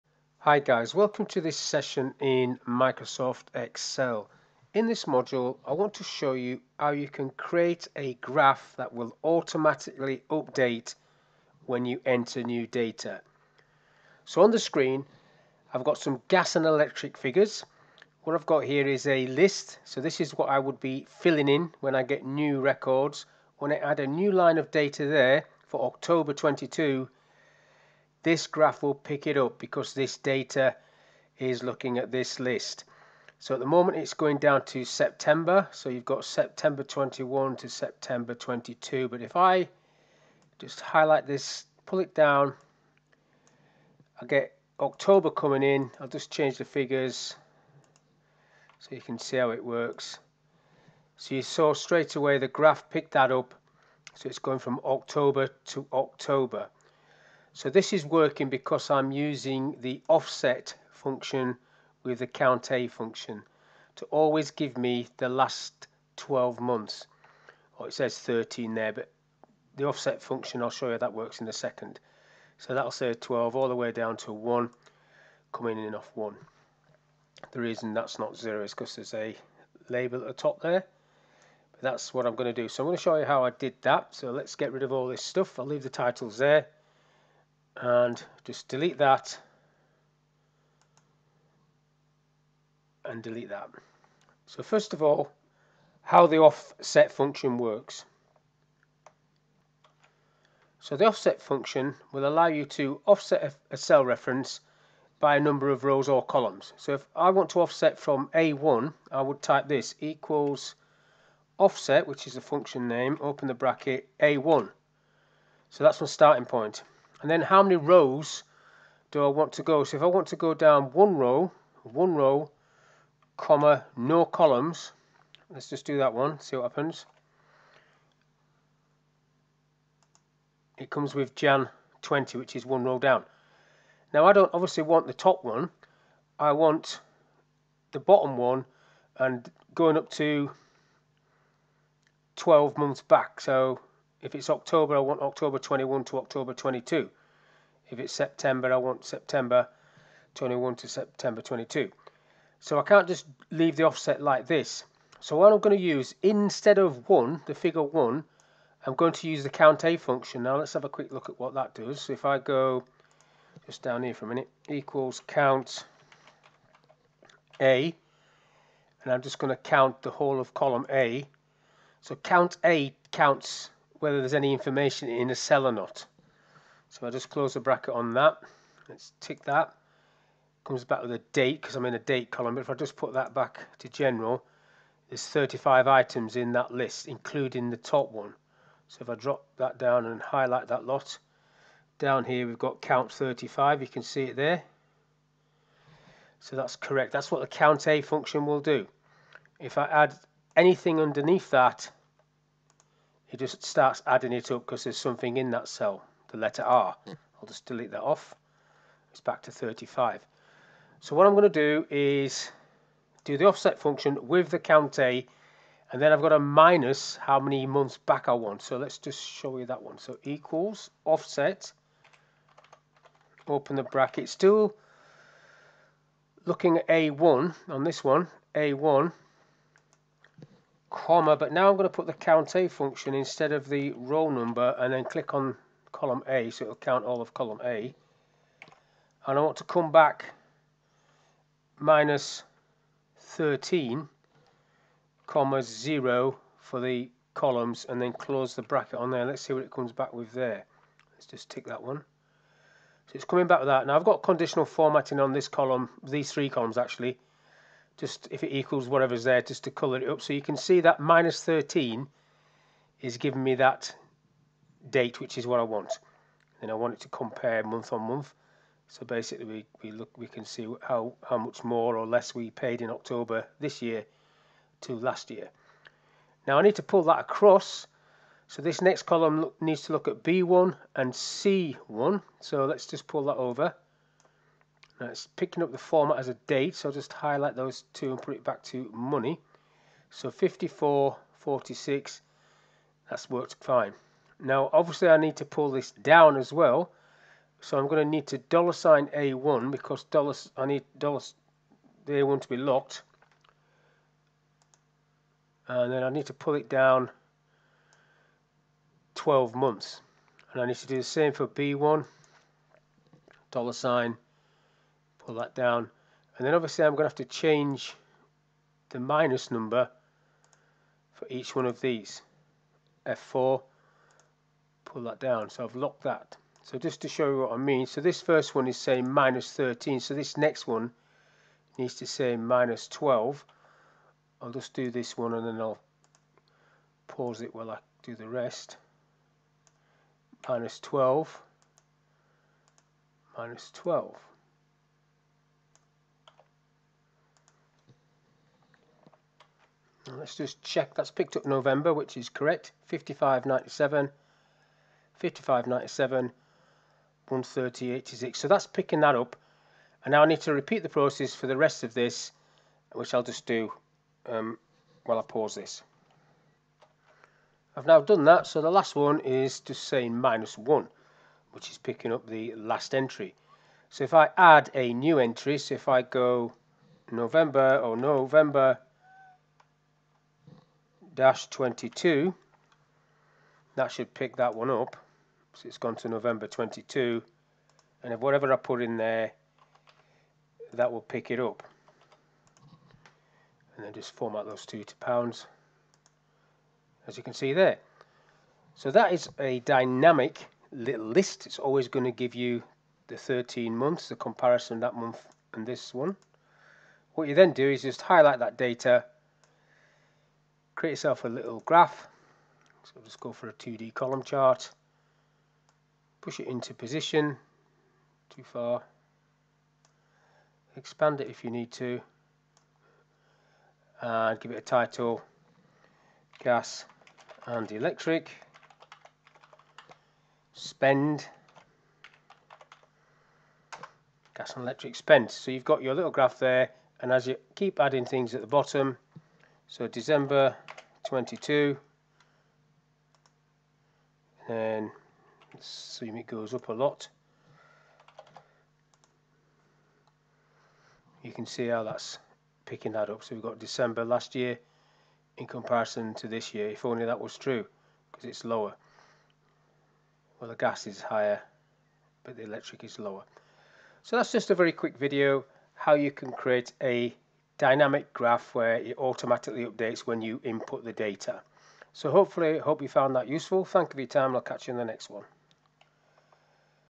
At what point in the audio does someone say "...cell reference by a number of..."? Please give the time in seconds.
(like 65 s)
103 s.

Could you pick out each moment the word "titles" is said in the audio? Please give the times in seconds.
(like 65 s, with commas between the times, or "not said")
85 s, 424 s.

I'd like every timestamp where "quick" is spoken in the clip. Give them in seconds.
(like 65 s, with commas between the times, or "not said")
160 s, 464 s.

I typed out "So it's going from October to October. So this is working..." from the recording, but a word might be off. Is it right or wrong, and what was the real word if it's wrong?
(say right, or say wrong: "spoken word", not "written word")
right.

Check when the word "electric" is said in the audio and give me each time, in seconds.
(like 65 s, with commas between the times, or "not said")
16 s, 427 s, 434 s, 462 s.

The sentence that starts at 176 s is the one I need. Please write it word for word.
So i just close the bracket on that.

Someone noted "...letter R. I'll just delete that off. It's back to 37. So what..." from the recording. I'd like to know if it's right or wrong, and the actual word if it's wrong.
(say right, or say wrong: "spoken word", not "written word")
wrong: "35", not "37".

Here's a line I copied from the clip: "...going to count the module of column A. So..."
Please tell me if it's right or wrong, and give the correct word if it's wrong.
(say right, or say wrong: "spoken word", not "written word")
wrong: "whole", not "module".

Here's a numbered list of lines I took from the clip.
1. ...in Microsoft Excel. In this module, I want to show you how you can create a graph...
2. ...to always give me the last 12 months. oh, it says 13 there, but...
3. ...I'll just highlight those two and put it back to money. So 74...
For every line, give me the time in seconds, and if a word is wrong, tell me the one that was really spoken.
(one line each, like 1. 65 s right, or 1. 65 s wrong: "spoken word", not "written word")
1. 2 s right
2. 63 s right
3. 286 s wrong: "54", not "74".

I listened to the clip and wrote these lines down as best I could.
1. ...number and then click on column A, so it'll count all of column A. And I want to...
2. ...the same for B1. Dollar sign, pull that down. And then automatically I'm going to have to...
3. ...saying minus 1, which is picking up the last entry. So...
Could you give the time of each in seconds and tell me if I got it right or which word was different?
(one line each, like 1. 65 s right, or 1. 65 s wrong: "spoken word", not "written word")
1. 234 s right
2. 310 s wrong: "obviously", not "automatically"
3. 369 s right.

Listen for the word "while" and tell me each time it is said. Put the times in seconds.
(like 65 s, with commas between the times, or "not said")
337 s, 365 s.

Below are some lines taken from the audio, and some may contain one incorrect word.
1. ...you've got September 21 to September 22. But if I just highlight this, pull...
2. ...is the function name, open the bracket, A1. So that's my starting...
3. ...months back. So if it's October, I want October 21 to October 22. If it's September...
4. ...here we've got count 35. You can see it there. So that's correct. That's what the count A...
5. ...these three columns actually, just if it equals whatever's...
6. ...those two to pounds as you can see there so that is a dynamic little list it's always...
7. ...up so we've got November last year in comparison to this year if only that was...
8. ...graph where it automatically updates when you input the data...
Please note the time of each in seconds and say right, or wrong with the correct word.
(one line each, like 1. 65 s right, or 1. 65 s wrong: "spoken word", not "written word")
1. 35 s right
2. 112 s right
3. 142 s right
4. 192 s right
5. 256 s right
6. 394 s right
7. 453 s wrong: "December", not "November"
8. 468 s right.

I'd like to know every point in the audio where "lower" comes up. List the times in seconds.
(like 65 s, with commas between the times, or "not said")
458 s, 462 s.